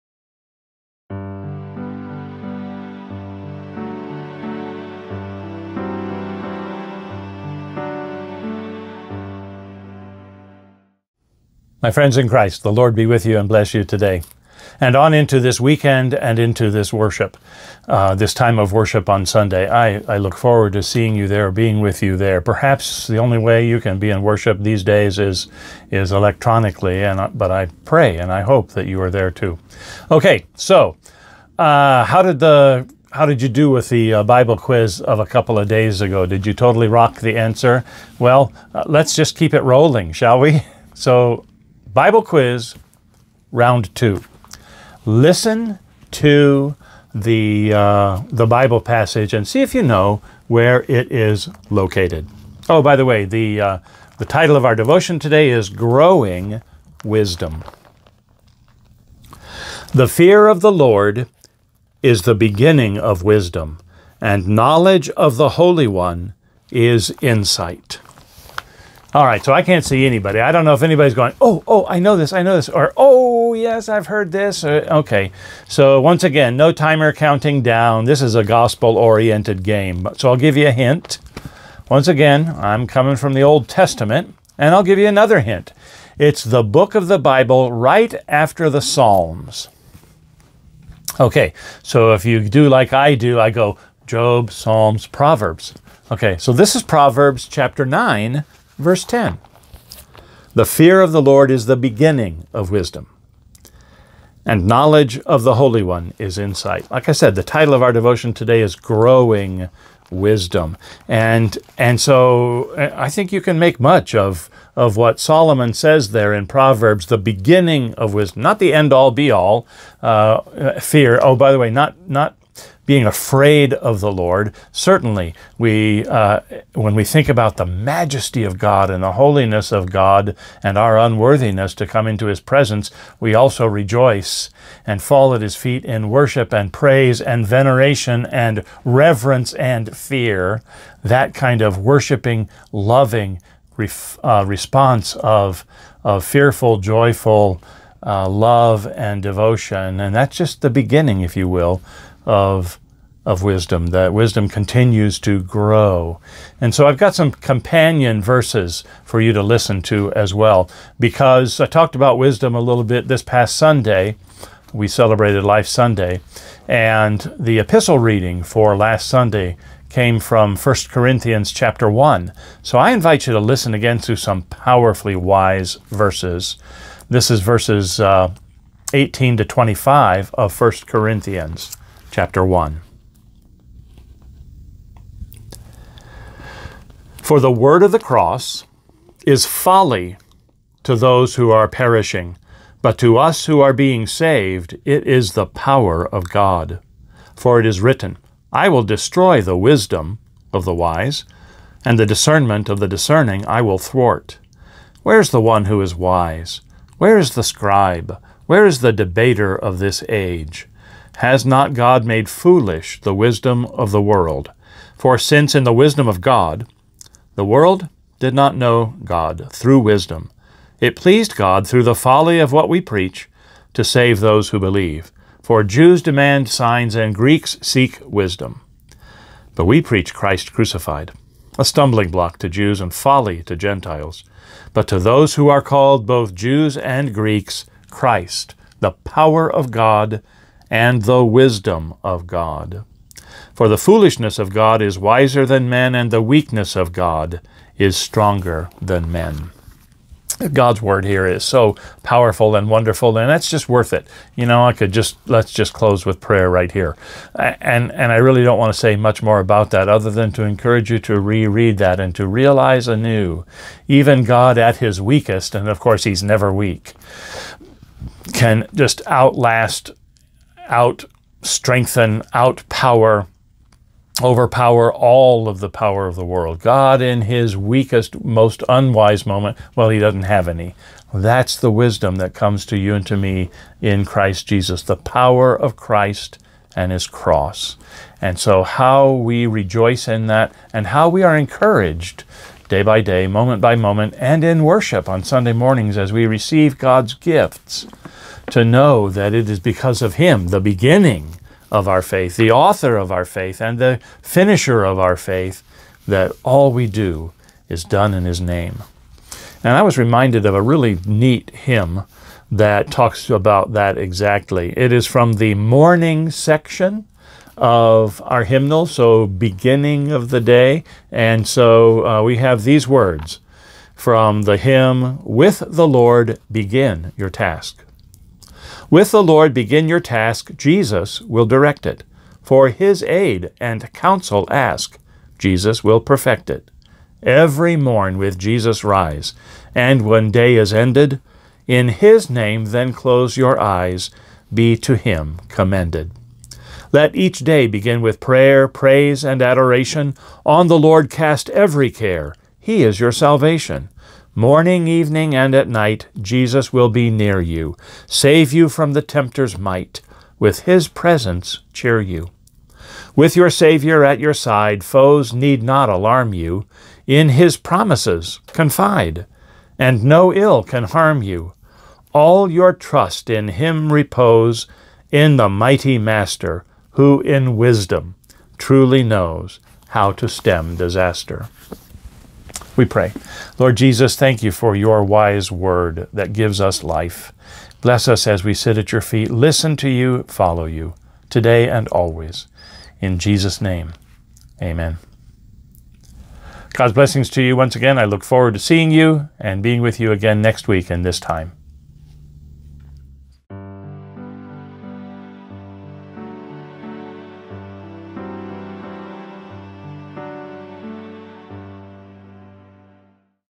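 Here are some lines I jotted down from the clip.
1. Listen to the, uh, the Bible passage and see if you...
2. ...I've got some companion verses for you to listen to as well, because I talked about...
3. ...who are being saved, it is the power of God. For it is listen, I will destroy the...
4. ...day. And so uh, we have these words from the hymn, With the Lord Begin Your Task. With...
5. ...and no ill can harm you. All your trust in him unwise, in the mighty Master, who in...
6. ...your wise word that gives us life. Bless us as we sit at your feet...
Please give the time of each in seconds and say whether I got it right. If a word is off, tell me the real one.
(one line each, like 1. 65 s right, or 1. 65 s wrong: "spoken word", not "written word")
1. 45 s right
2. 156 s right
3. 193 s wrong: "written", not "listen"
4. 320 s right
5. 369 s wrong: "repose", not "unwise"
6. 384 s right.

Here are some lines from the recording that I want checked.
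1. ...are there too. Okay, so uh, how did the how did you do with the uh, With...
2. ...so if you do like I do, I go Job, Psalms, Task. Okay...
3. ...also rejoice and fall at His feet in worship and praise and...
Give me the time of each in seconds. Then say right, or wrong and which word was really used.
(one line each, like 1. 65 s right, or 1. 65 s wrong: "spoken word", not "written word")
1. 29 s wrong: "Bible", not "With"
2. 91 s wrong: "Proverbs", not "Task"
3. 133 s right.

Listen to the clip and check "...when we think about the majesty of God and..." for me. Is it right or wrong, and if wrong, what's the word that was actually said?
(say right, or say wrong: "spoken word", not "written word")
right.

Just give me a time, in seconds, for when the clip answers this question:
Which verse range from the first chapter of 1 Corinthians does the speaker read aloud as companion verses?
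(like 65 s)
178 s.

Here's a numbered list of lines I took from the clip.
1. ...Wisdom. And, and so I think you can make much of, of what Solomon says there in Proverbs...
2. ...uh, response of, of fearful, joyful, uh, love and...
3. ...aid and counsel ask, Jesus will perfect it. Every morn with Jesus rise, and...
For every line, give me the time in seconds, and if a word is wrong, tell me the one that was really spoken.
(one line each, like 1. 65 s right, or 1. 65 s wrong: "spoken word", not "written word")
1. 110 s right
2. 144 s right
3. 333 s right.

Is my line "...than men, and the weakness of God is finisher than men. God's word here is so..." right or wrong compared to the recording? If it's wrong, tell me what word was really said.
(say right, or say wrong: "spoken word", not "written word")
wrong: "stronger", not "finisher".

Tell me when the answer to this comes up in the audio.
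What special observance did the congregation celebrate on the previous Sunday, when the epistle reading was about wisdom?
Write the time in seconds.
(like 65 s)
165 s.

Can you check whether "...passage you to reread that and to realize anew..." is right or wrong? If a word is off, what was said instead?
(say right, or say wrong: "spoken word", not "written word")
wrong: "encourage", not "passage".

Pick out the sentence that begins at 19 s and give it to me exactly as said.
I, I look forward to seeing you there, being with you there.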